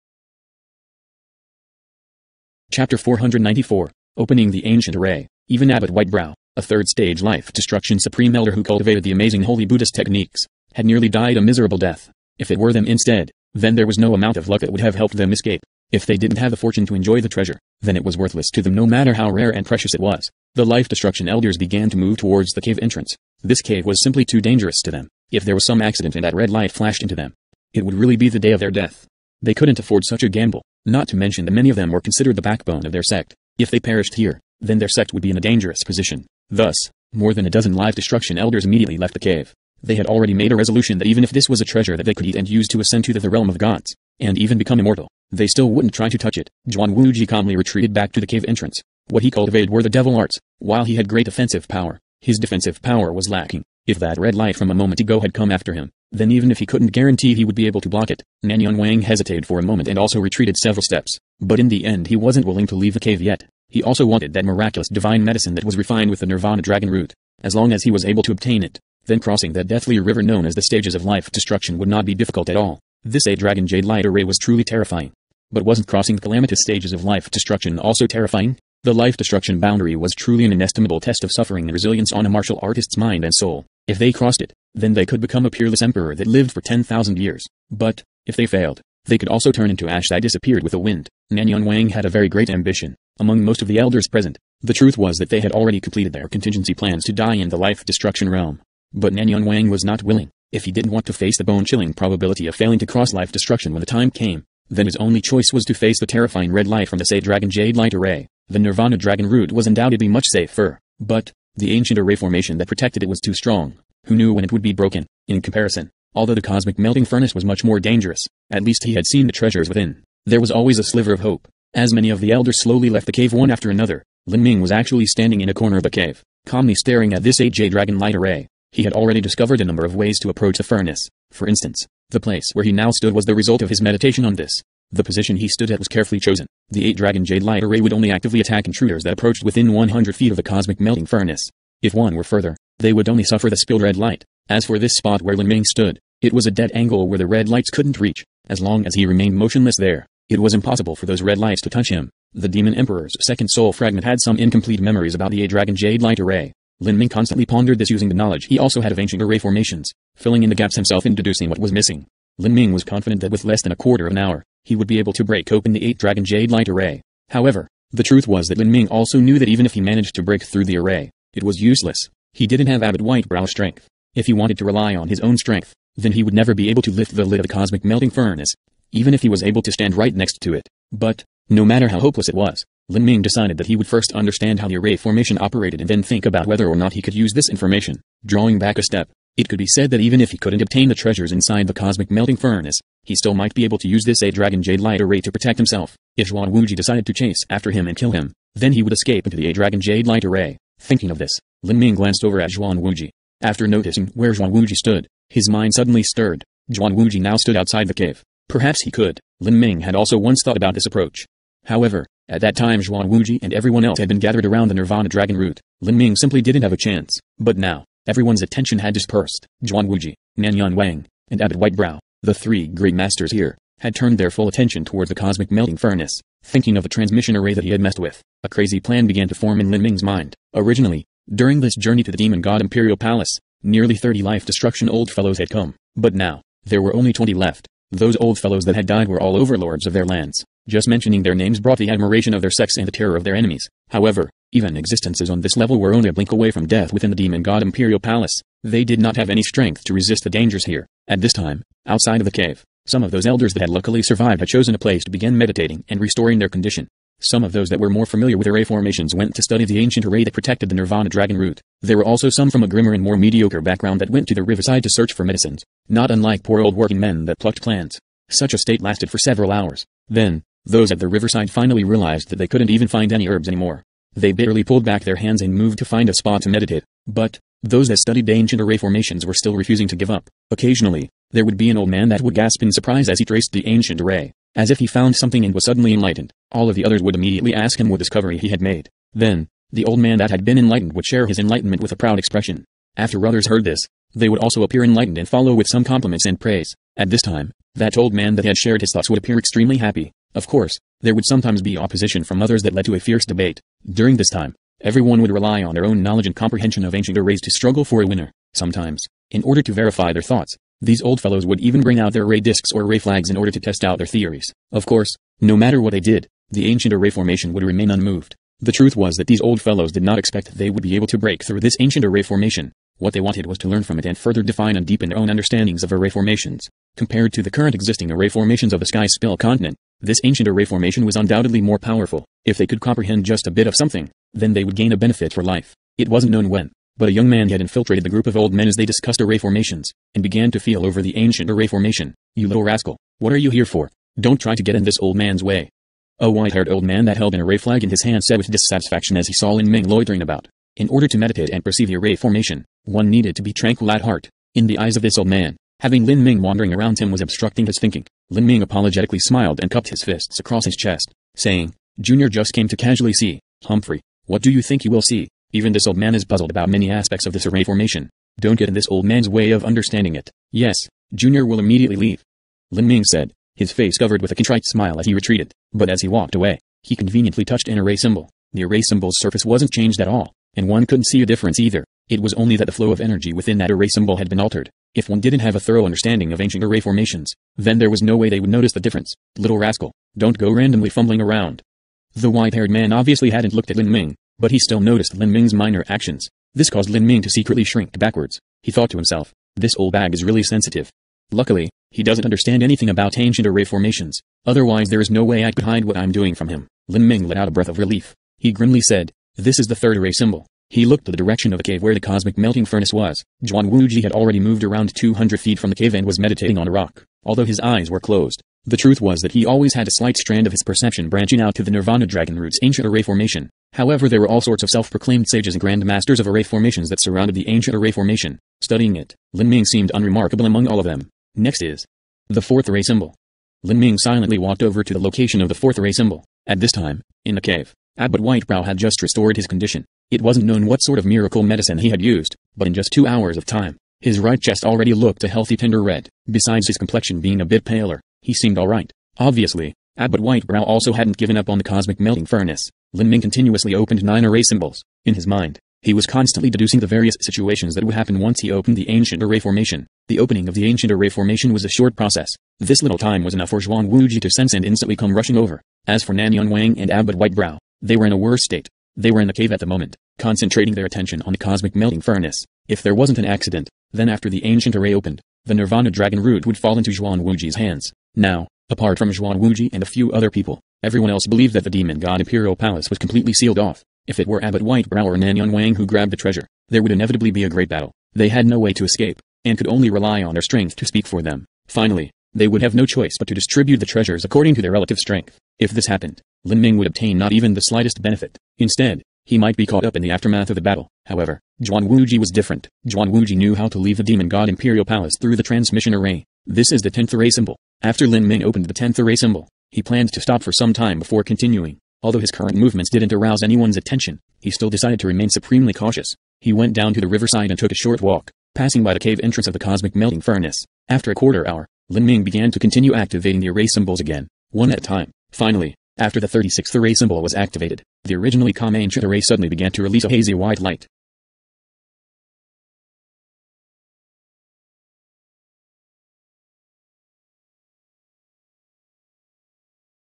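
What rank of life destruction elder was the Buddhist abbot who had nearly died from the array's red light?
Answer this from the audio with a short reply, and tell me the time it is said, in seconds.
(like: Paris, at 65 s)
Third stage, at 6 s.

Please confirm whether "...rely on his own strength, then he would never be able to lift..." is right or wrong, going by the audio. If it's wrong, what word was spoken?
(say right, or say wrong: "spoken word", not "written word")
right.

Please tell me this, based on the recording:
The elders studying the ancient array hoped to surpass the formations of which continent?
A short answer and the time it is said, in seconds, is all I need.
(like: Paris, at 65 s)
Sky Spill continent, at 328 s.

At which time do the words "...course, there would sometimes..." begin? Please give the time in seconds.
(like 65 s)
300 s.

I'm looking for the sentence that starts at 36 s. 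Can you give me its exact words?
Thus, more than a dozen life destruction elders immediately left the cave.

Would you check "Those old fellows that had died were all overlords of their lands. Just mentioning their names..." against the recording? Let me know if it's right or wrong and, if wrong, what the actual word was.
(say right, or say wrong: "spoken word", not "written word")
right.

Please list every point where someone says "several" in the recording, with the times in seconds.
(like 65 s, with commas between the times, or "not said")
60 s, 269 s.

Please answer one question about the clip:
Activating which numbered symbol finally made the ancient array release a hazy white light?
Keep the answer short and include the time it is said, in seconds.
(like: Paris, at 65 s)
36th, at 526 s.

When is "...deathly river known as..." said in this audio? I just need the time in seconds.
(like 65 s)
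69 s.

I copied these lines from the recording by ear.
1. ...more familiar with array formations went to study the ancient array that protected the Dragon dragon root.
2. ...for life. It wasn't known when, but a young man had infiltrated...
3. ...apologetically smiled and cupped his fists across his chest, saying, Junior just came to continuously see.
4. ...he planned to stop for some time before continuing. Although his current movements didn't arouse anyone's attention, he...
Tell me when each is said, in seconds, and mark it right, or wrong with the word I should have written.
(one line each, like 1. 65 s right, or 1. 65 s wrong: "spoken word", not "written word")
1. 257 s wrong: "Nirvana", not "Dragon"
2. 335 s right
3. 358 s wrong: "casually", not "continuously"
4. 509 s right.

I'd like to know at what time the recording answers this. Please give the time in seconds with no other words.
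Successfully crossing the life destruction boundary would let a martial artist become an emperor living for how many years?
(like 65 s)
86 s.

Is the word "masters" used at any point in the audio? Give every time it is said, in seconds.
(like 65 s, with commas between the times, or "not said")
222 s, 425 s.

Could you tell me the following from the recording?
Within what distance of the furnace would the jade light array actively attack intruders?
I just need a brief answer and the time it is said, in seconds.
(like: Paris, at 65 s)
100 feet, at 139 s.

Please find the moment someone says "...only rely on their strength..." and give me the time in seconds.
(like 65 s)
489 s.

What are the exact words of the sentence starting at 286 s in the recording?
All of the others would immediately ask him what discovery he had made.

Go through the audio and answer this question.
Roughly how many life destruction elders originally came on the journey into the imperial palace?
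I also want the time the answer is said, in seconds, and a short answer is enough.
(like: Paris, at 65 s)
Nearly 30, at 233 s.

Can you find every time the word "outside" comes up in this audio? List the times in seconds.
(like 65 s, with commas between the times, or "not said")
207 s, 251 s.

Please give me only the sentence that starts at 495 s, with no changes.
If this happened, Lin Ming would obtain not even the slightest benefit.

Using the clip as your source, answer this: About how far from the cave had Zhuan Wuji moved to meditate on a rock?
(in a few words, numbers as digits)
200 feet.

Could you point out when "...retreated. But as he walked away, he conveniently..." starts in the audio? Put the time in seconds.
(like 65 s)
375 s.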